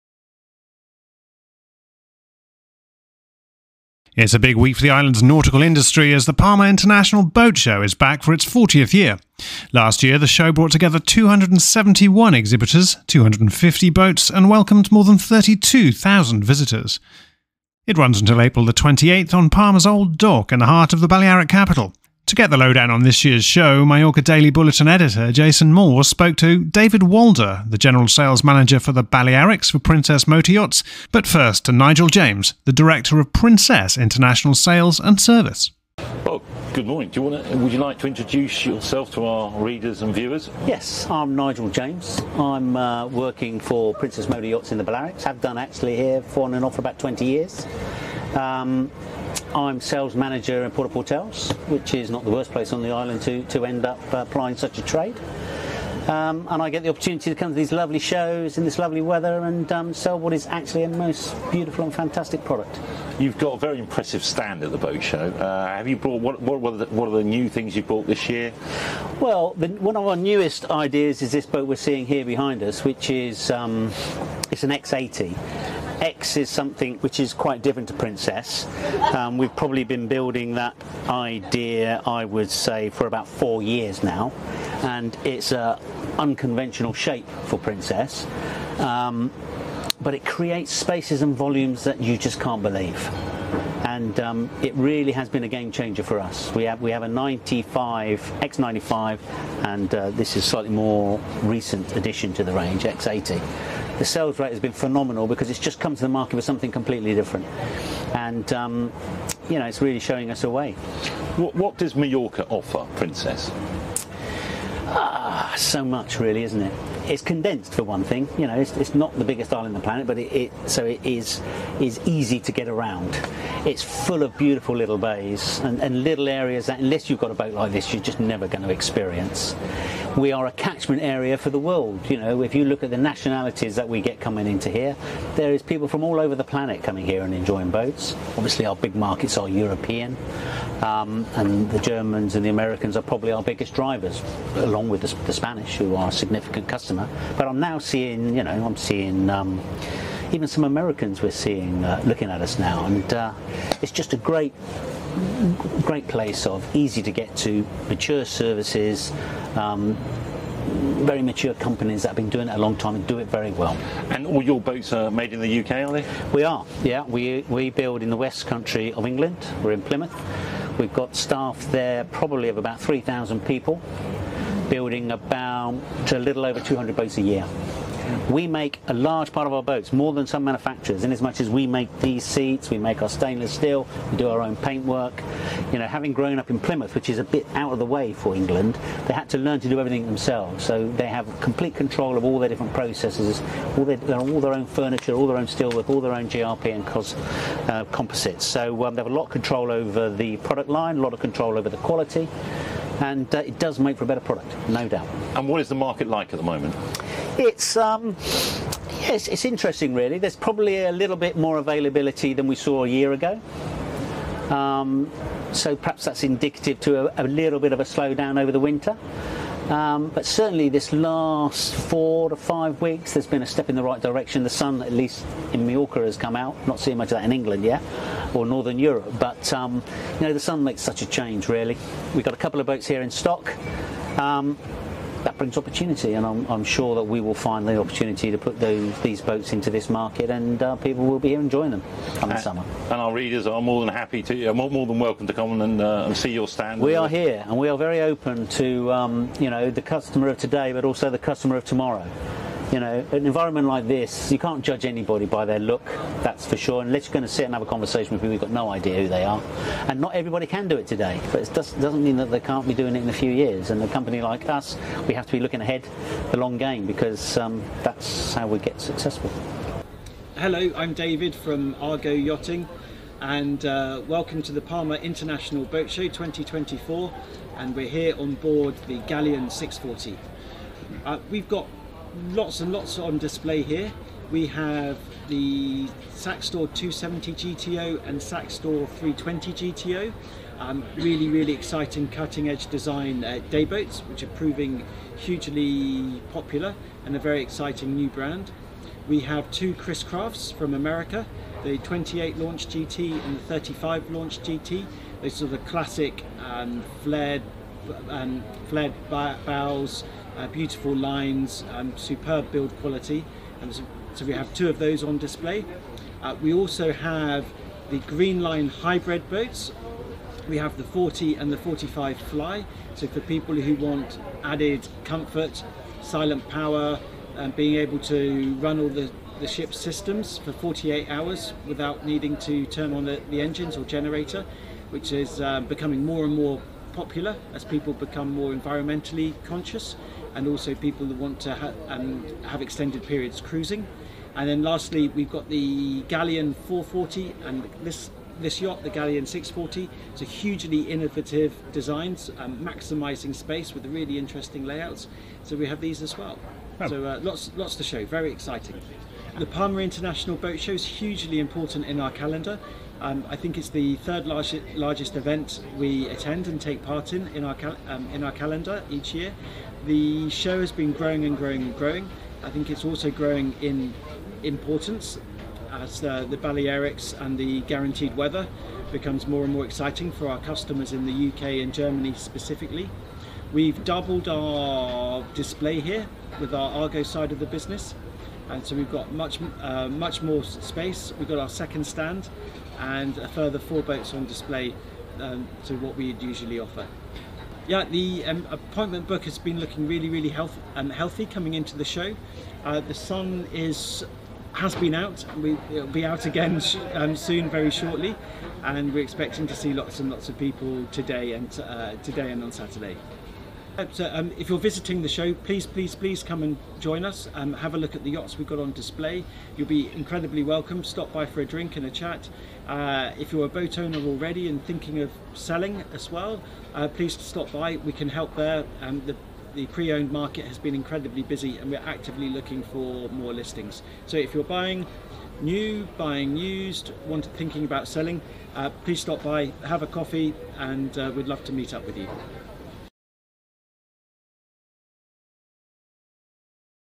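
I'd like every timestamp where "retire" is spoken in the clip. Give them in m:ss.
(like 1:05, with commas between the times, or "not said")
not said.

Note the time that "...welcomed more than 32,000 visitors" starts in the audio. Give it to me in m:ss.
0:14.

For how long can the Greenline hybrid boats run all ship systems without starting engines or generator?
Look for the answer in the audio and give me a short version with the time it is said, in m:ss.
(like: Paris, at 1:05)
48 hours, at 5:30.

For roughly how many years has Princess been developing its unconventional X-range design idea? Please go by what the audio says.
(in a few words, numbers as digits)
4 years.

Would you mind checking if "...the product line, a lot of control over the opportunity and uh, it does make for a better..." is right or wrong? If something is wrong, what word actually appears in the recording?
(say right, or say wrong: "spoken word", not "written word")
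wrong: "quality", not "opportunity".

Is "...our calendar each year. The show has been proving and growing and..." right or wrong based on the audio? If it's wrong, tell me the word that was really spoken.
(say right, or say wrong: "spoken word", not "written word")
wrong: "growing", not "proving".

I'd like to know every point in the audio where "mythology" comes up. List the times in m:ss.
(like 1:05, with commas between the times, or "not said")
not said.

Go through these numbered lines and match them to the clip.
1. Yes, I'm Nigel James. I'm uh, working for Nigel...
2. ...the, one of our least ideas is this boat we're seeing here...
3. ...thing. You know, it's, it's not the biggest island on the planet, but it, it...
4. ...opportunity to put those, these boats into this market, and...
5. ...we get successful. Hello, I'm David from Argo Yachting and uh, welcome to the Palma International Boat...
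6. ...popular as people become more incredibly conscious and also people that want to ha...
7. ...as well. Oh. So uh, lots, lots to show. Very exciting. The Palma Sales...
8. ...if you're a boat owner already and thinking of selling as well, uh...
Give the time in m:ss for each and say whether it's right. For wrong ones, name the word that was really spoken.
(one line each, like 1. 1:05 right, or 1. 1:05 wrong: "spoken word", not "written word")
1. 0:40 wrong: "Princess", not "Nigel"
2. 1:09 wrong: "newest", not "least"
3. 1:58 right
4. 3:57 right
5. 4:28 right
6. 5:36 wrong: "environmentally", not "incredibly"
7. 5:56 wrong: "International", not "Sales"
8. 7:03 right.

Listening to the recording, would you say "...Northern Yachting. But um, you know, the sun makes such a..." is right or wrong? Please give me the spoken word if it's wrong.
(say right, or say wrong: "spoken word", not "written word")
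wrong: "Europe", not "Yachting".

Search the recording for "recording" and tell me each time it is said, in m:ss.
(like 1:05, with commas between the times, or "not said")
not said.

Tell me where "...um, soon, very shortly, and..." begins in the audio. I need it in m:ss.
6:46.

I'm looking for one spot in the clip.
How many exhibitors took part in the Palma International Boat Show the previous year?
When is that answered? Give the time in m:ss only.
0:10.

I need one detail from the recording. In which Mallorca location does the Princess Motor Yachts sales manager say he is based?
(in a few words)
Puerto Portals.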